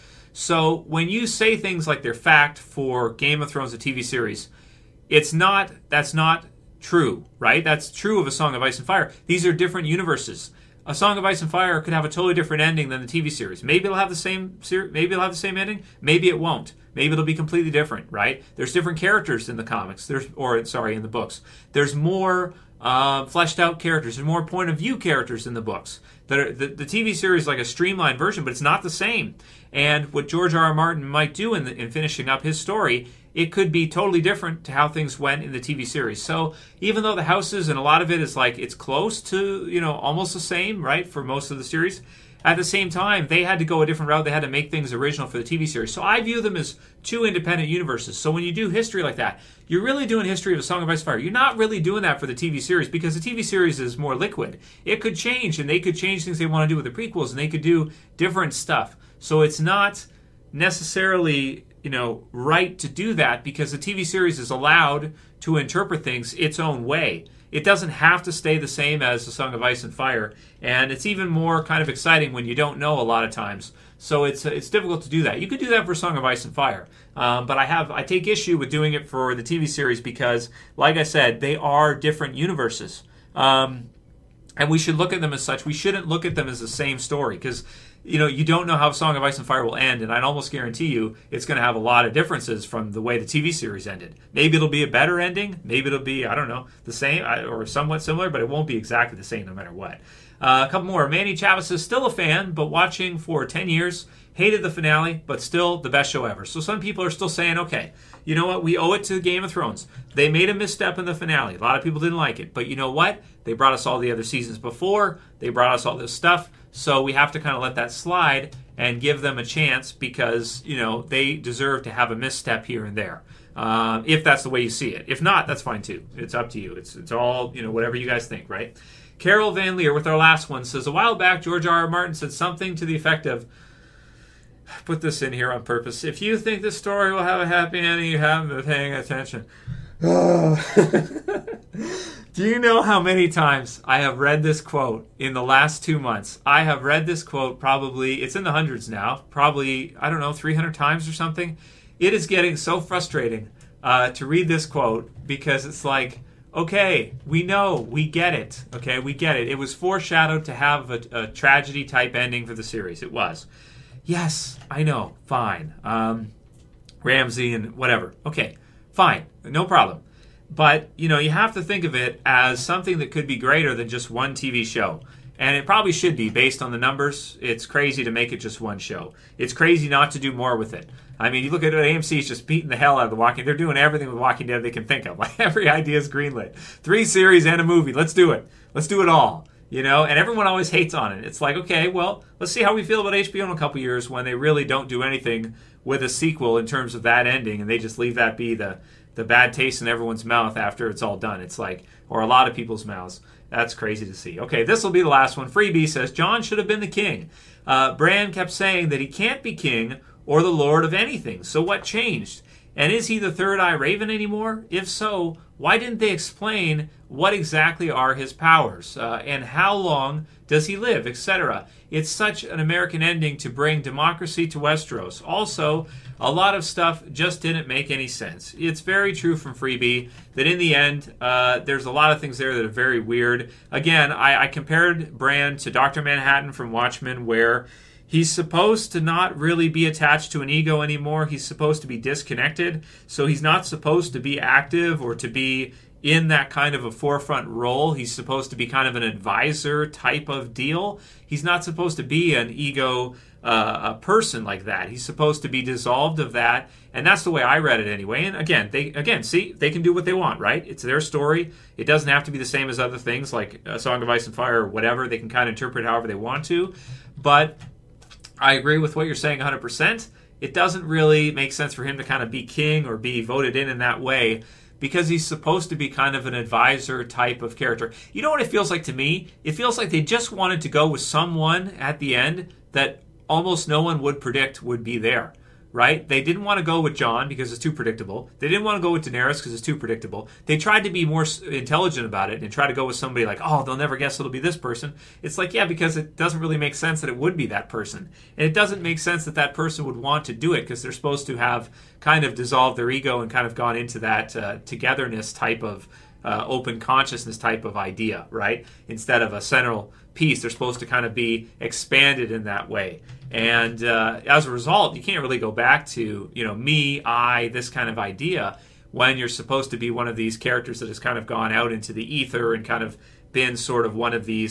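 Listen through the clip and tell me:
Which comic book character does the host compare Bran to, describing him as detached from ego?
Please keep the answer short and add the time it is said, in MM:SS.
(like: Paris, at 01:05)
Dr. Manhattan, at 03:55.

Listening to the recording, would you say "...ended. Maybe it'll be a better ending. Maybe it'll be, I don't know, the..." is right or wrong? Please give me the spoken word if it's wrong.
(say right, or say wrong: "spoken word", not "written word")
right.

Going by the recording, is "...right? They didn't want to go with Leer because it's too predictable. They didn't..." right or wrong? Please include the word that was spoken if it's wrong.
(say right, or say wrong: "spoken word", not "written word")
wrong: "Jon", not "Leer".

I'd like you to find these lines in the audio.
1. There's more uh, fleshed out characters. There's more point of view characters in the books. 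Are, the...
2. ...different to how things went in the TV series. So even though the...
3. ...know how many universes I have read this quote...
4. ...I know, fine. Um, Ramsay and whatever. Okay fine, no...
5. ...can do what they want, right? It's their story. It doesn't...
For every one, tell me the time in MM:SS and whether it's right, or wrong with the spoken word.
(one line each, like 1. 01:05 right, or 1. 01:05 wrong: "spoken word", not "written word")
1. 00:21 right
2. 00:34 right
3. 02:22 wrong: "times", not "universes"
4. 02:44 right
5. 04:19 right.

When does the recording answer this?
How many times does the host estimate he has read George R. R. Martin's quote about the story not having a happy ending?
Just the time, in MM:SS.
02:30.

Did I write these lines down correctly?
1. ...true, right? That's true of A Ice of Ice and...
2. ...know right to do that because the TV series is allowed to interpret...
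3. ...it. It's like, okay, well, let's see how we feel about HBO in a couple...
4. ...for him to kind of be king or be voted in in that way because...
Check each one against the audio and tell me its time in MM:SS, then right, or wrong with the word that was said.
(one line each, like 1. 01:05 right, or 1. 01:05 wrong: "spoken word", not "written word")
1. 00:06 wrong: "Song", not "Ice"
2. 01:01 right
3. 03:11 right
4. 04:31 right.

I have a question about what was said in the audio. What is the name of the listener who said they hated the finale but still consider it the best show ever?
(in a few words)
Manny Chavis.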